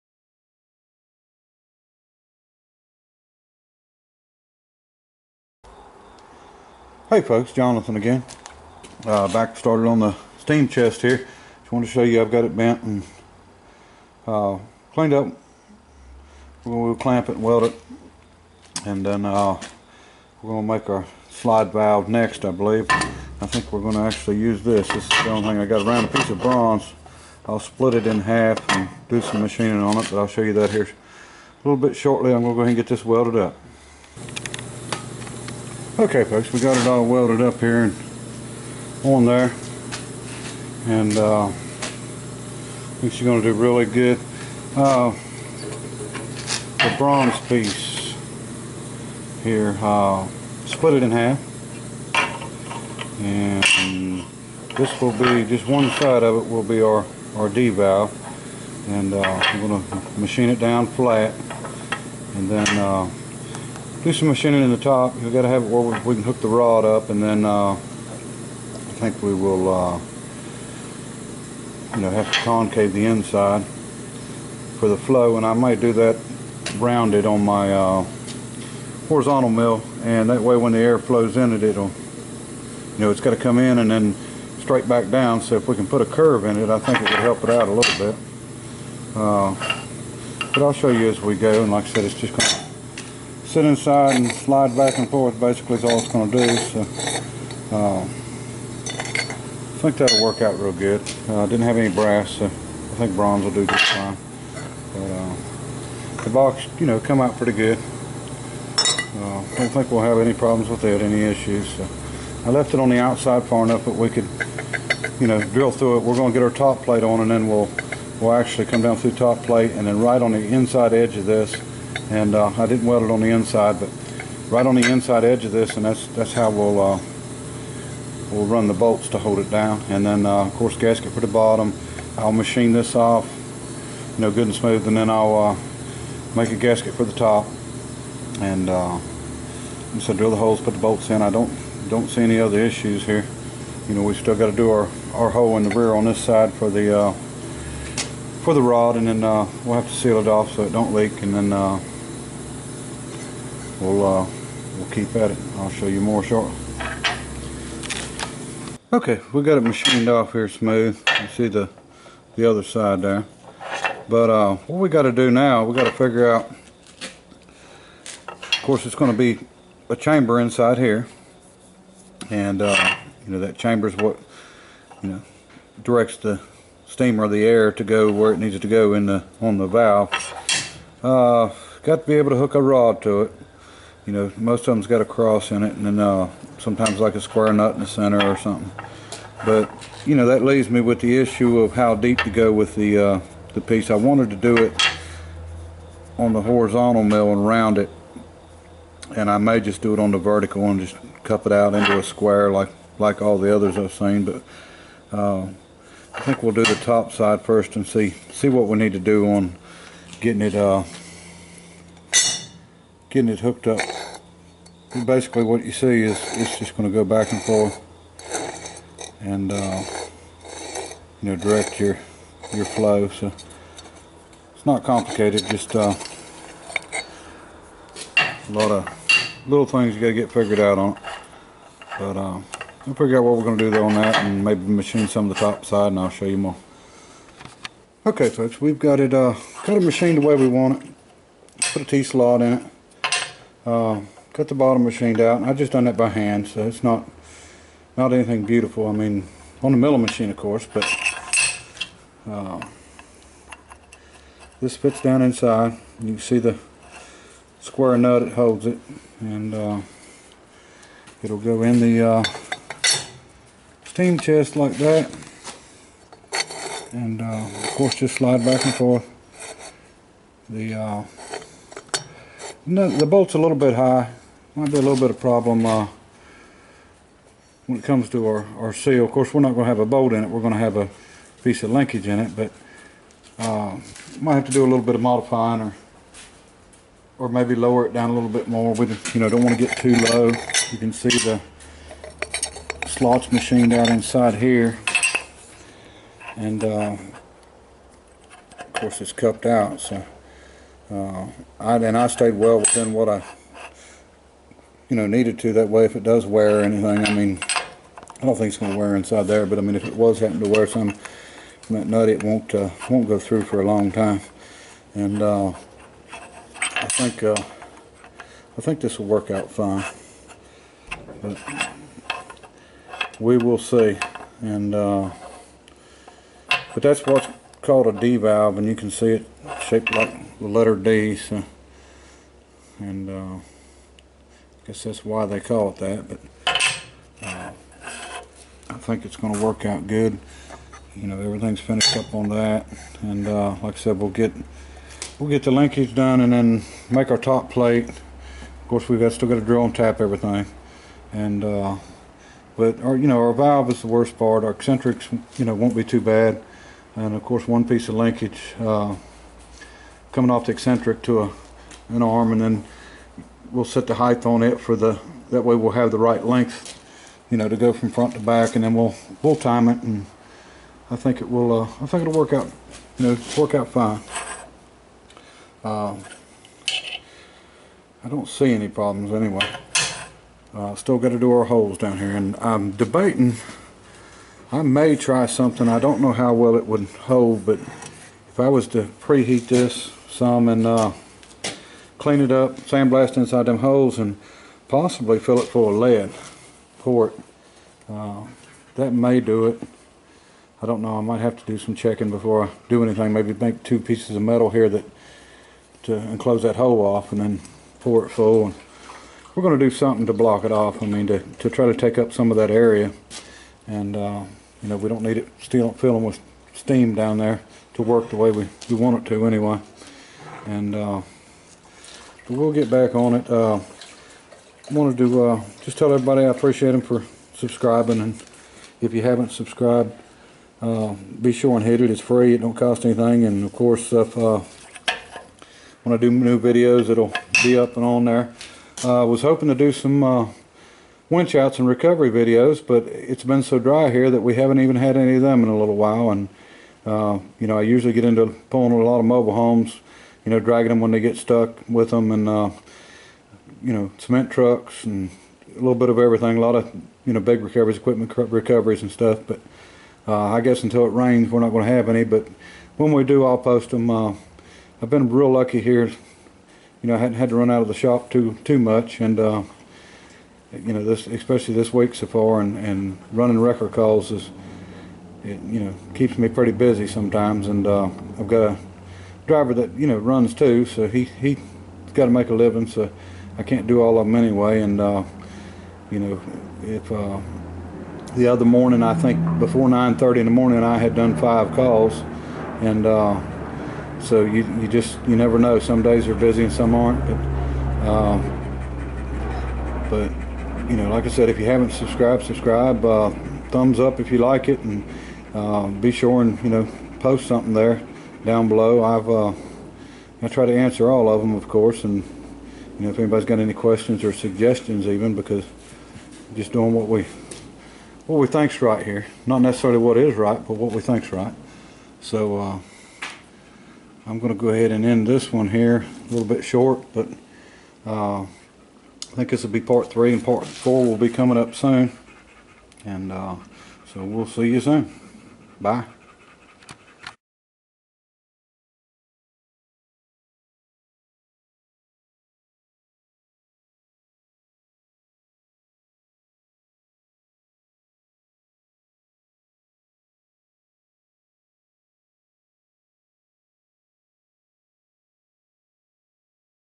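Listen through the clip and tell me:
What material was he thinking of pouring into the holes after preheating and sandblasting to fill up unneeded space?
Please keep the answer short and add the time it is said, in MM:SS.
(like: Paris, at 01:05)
lead, at 06:35.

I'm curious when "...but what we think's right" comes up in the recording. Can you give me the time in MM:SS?
08:40.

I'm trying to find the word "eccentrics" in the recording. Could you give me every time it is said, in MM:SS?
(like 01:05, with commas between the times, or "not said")
05:54, 06:00.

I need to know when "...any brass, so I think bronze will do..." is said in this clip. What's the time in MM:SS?
01:41.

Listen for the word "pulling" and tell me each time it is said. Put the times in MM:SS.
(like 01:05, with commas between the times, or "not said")
07:28.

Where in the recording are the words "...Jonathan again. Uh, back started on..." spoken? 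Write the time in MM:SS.
00:07.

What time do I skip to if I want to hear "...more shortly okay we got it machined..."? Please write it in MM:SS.
02:36.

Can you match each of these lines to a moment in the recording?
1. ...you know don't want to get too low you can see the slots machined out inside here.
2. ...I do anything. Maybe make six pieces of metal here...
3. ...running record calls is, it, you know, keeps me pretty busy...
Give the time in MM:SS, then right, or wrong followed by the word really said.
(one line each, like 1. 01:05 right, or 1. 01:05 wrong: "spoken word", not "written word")
1. 04:49 right
2. 06:42 wrong: "two", not "six"
3. 07:53 right.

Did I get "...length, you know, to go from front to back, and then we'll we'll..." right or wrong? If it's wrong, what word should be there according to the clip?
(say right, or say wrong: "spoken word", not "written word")
right.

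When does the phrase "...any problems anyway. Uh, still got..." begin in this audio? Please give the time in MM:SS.
06:18.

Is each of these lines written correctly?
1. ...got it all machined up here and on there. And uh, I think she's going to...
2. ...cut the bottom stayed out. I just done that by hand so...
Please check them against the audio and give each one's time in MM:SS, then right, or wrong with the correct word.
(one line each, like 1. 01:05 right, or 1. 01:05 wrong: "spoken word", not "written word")
1. 00:36 wrong: "welded", not "machined"
2. 04:04 wrong: "machined", not "stayed".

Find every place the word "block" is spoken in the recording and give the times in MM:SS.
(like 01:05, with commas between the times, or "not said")
06:50.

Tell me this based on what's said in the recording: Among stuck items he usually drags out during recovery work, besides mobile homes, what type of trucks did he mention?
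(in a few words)
cement trucks.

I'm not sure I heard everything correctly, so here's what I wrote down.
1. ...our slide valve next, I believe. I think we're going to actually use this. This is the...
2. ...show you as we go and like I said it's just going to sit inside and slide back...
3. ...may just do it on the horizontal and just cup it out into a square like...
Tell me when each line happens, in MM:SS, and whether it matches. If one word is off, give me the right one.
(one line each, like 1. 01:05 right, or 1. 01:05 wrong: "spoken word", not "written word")
1. 00:20 right
2. 01:30 right
3. 03:19 wrong: "vertical", not "horizontal".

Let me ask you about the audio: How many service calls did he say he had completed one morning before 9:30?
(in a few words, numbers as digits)
5.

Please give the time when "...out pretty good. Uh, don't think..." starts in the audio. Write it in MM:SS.
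01:47.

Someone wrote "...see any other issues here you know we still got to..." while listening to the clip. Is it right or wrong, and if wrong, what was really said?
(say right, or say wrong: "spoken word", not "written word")
right.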